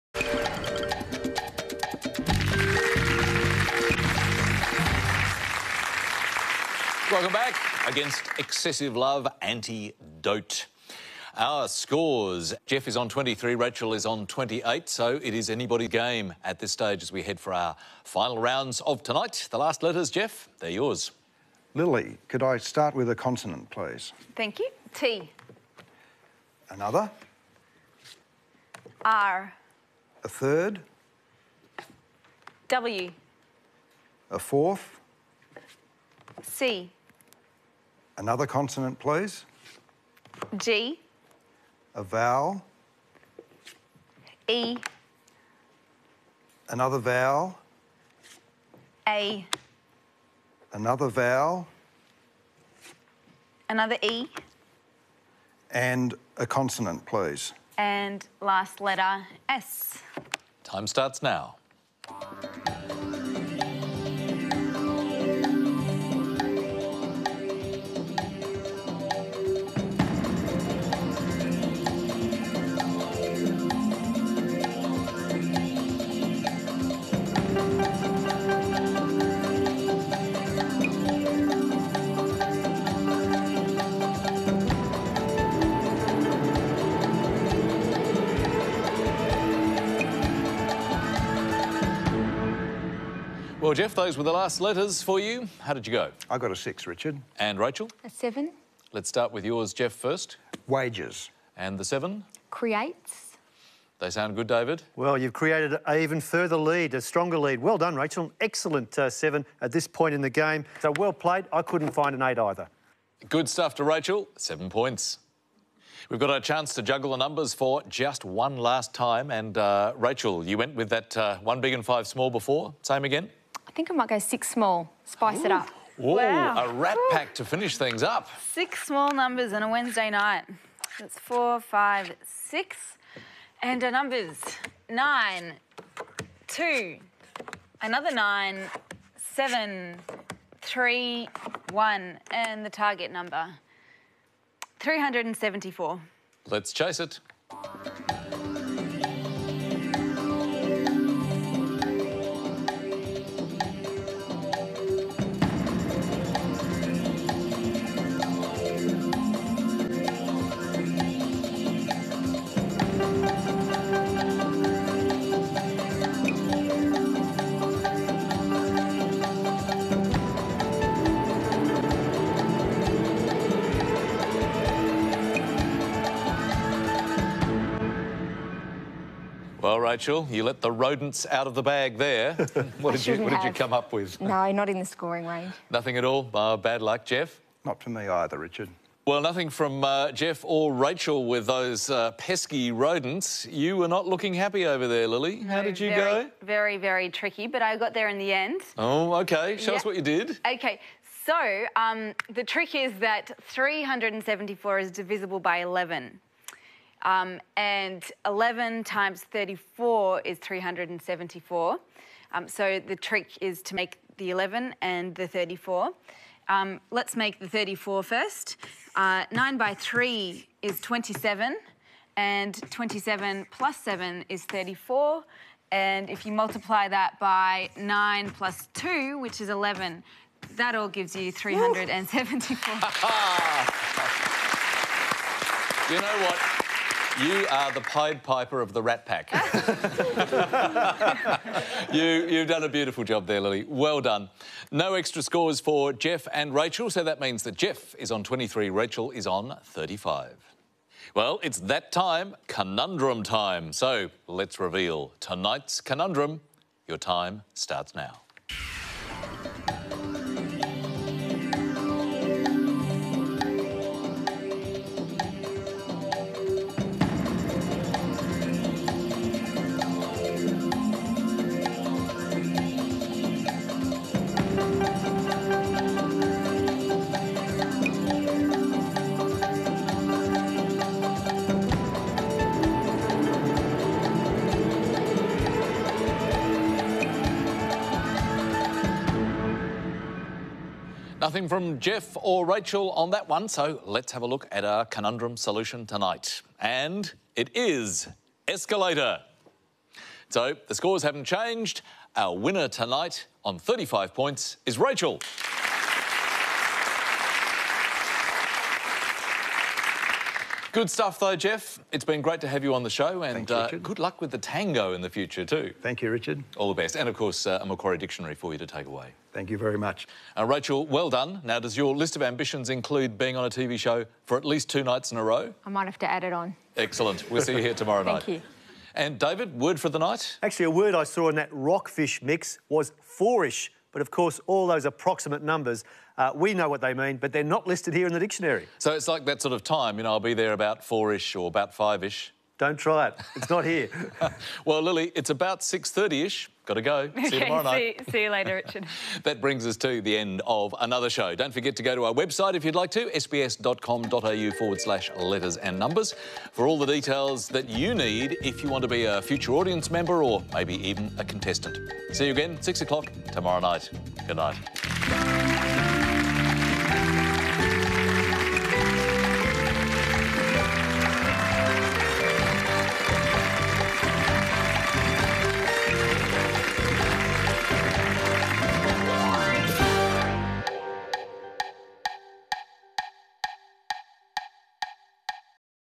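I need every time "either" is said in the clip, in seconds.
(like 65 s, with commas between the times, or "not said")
112 s, 188 s.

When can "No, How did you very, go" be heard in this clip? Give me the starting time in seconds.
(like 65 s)
195 s.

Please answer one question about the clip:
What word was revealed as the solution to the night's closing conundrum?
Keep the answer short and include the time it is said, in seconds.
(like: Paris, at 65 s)
escalator, at 298 s.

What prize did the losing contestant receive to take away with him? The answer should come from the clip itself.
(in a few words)
a Macquarie Dictionary.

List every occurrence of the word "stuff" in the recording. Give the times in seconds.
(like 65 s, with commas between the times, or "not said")
113 s, 310 s.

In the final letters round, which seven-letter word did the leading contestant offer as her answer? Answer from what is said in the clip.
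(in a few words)
creates.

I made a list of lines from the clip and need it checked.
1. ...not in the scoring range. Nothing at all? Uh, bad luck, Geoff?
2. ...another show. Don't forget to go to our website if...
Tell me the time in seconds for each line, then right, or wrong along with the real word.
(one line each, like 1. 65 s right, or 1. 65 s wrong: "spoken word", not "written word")
1. 184 s right
2. 350 s right.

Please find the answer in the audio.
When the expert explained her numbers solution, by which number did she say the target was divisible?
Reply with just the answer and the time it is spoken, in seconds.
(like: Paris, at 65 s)
11, at 204 s.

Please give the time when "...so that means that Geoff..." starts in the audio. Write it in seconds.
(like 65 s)
246 s.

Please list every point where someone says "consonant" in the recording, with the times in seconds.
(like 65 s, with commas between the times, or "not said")
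23 s, 38 s, 56 s.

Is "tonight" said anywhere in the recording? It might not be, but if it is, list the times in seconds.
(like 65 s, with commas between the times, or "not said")
19 s, 255 s, 295 s, 302 s.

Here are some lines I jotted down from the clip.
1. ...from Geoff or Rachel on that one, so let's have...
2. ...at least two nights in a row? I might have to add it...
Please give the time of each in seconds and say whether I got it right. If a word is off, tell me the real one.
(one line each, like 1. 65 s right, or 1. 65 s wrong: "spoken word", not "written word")
1. 291 s right
2. 324 s right.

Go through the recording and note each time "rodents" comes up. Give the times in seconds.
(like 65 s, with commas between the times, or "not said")
180 s, 192 s.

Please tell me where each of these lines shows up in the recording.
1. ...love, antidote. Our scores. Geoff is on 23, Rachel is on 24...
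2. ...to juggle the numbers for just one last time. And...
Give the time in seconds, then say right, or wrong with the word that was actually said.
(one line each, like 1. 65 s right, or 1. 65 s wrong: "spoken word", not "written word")
1. 8 s wrong: "28", not "24"
2. 116 s right.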